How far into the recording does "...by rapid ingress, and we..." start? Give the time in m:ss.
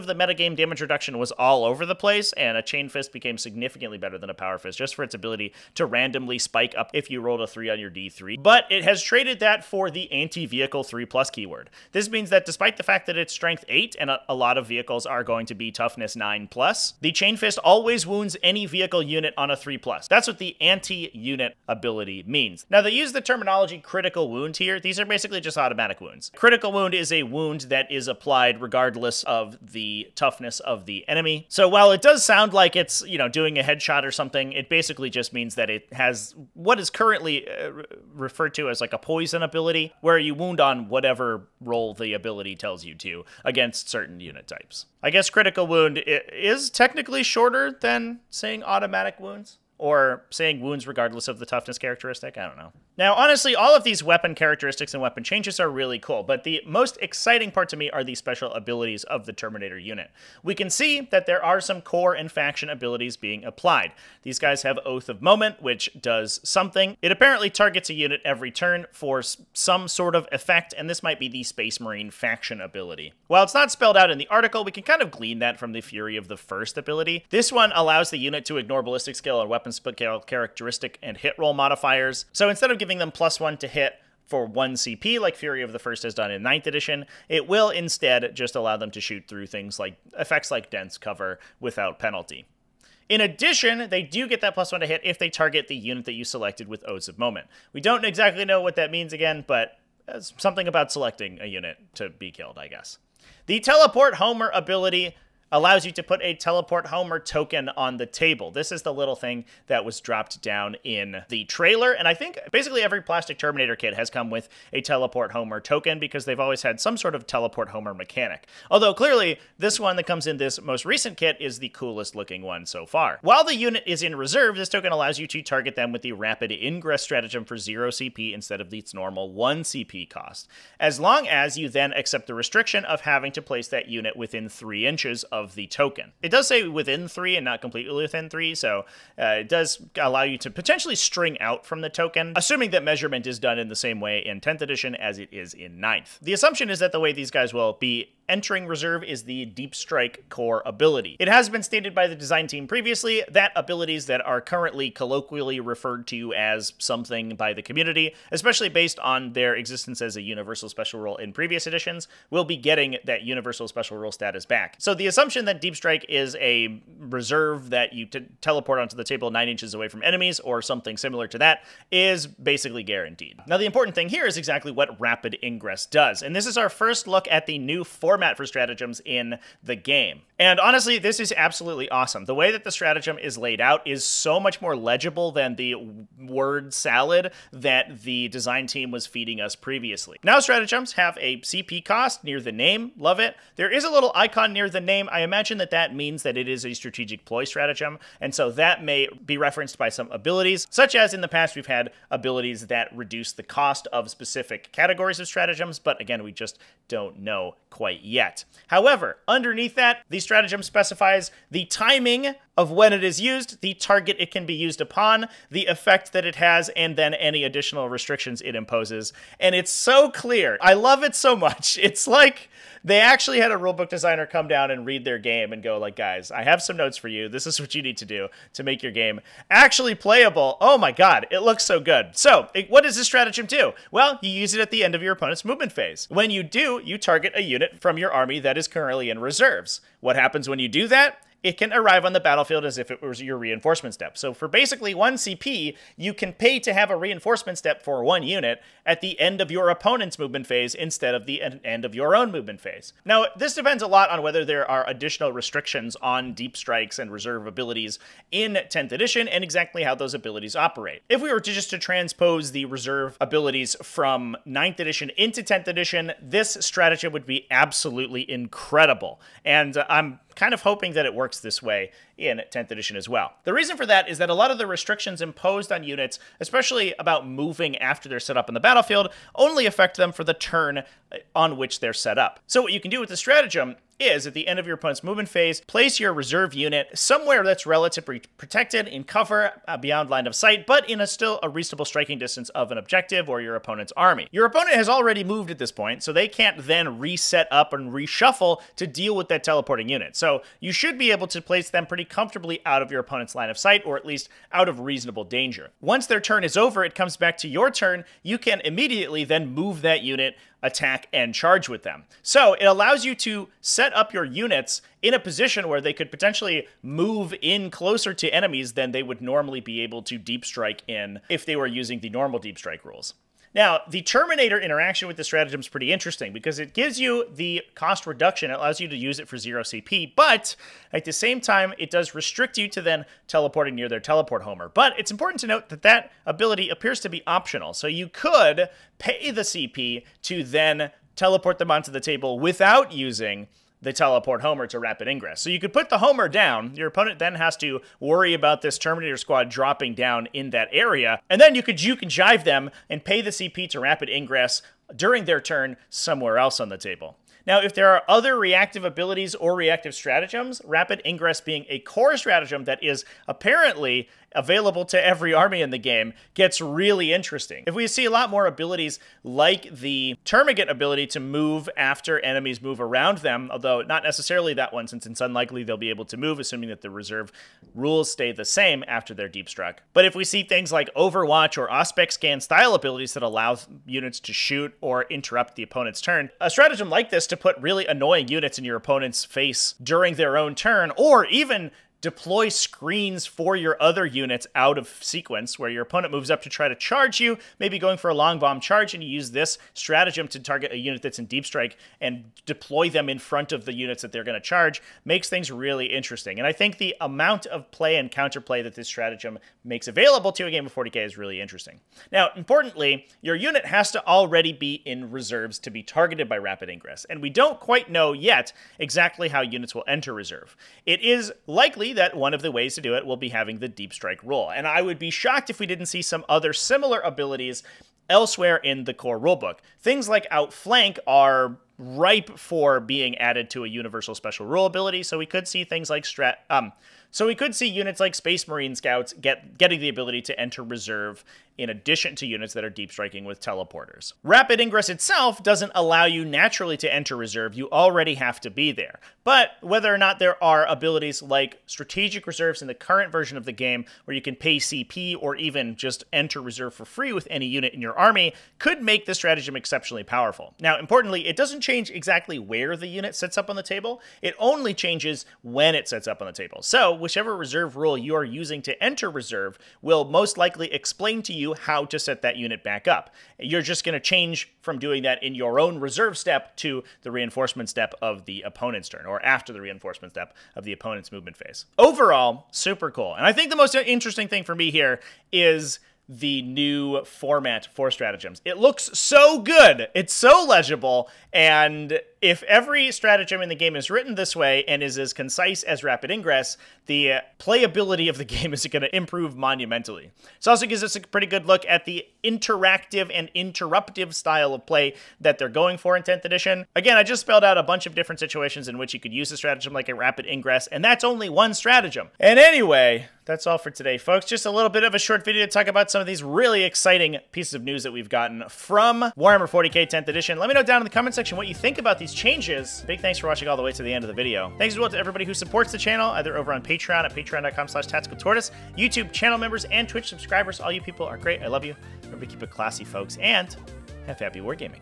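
6:56.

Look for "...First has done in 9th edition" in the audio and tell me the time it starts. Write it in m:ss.
1:25.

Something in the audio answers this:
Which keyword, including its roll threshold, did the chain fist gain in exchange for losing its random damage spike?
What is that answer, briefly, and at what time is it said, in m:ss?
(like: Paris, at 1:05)
anti-vehicle 3+, at 0:10.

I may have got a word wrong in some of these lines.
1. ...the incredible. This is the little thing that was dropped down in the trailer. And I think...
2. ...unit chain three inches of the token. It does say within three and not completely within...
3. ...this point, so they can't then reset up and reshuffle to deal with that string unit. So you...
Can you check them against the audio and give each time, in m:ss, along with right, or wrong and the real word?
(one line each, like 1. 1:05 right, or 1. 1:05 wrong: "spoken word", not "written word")
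1. 1:47 wrong: "table", not "incredible"
2. 2:13 wrong: "within", not "chain"
3. 4:55 wrong: "teleporting", not "string".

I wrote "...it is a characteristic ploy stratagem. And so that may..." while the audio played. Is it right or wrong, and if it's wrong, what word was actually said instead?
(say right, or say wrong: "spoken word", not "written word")
wrong: "strategic", not "characteristic".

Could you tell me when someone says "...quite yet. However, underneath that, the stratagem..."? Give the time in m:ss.
3:27.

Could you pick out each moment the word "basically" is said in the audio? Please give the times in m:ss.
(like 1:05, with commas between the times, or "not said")
0:25, 0:34, 1:52, 2:52, 4:04.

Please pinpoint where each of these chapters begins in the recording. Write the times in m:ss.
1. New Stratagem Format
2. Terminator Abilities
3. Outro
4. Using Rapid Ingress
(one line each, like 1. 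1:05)
1. 2:55
2. 0:52
3. 8:31
4. 4:12.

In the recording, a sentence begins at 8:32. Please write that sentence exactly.
And anyway, that's all for today, folks.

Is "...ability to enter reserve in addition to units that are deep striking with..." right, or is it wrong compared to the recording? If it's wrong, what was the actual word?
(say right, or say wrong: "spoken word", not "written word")
right.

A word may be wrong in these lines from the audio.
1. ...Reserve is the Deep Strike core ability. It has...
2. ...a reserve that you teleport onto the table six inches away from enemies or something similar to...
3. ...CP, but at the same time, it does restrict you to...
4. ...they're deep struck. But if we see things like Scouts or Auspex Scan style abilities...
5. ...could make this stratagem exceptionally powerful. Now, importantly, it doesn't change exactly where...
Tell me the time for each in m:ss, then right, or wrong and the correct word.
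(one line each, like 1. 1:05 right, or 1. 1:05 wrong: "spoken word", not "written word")
1. 2:28 right
2. 2:46 wrong: "nine", not "six"
3. 5:29 right
4. 6:19 wrong: "Overwatch", not "Scouts"
5. 7:38 right.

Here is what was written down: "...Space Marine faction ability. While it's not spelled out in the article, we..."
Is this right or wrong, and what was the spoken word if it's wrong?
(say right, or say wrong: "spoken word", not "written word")
right.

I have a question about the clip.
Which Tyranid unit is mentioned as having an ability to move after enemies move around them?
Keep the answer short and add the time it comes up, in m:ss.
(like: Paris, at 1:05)
Termagant, at 6:10.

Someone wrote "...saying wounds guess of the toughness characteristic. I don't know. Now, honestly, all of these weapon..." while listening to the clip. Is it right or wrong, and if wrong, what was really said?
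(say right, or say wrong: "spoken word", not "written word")
wrong: "regardless", not "guess".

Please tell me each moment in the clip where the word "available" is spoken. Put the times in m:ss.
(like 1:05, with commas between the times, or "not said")
6:04, 6:49.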